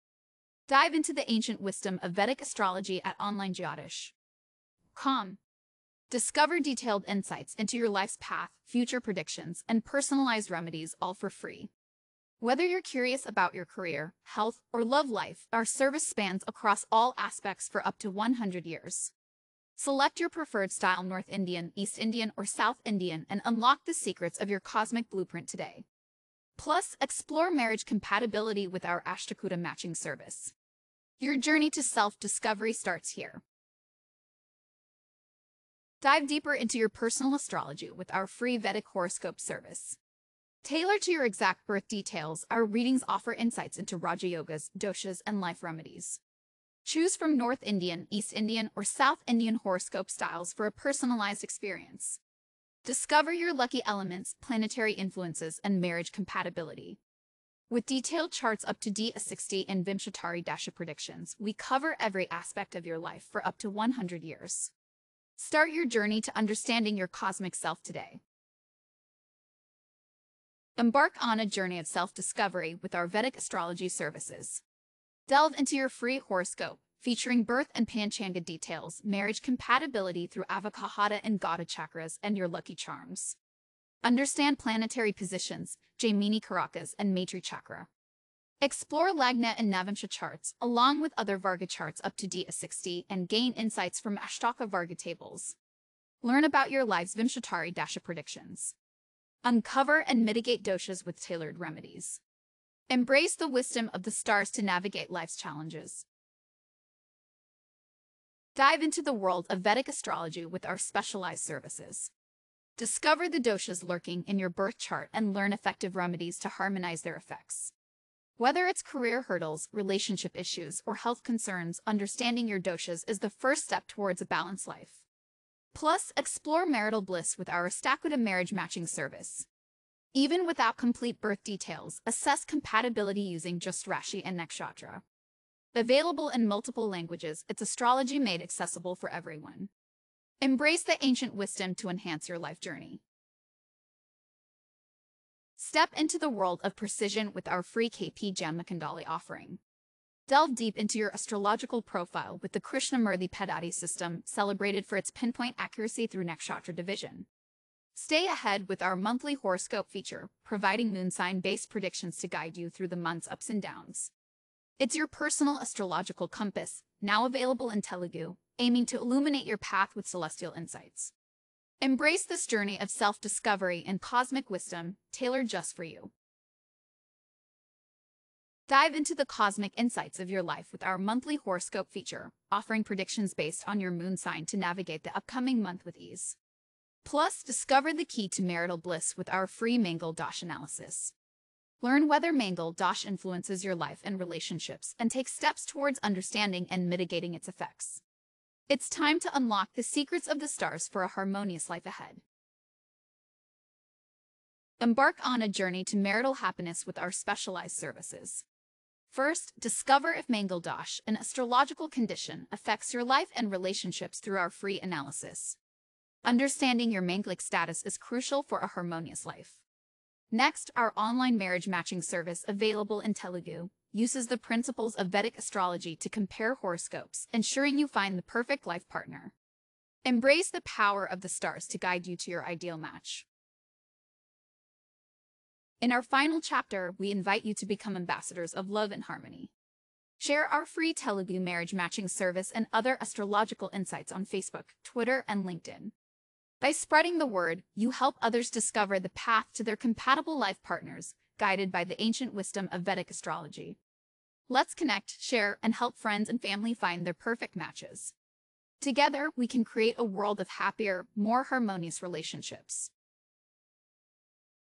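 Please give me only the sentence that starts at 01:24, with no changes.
Understand planetary positions, Jaimini Karakas and Maitri Chakra.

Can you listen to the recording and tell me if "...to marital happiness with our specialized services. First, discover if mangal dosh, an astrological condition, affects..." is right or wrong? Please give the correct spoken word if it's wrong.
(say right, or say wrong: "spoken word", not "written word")
right.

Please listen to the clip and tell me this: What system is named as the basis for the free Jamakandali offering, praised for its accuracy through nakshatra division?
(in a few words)
Krishnamurthy Paddhati.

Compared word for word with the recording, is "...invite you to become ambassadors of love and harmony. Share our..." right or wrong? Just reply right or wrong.
right.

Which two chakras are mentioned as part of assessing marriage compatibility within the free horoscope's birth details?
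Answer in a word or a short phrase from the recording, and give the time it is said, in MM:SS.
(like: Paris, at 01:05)
Avakahada and Gata, at 01:20.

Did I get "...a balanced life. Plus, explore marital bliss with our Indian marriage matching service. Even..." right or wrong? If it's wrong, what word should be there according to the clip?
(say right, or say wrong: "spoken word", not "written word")
wrong: "Ashtakuta", not "Indian".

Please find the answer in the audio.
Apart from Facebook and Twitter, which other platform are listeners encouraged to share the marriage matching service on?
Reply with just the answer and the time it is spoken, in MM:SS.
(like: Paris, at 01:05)
LinkedIn, at 04:05.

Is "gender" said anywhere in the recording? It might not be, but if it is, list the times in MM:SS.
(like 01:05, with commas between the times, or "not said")
not said.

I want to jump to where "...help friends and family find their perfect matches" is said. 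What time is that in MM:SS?
04:15.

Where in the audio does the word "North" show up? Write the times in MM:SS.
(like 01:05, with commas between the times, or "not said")
00:21, 00:47.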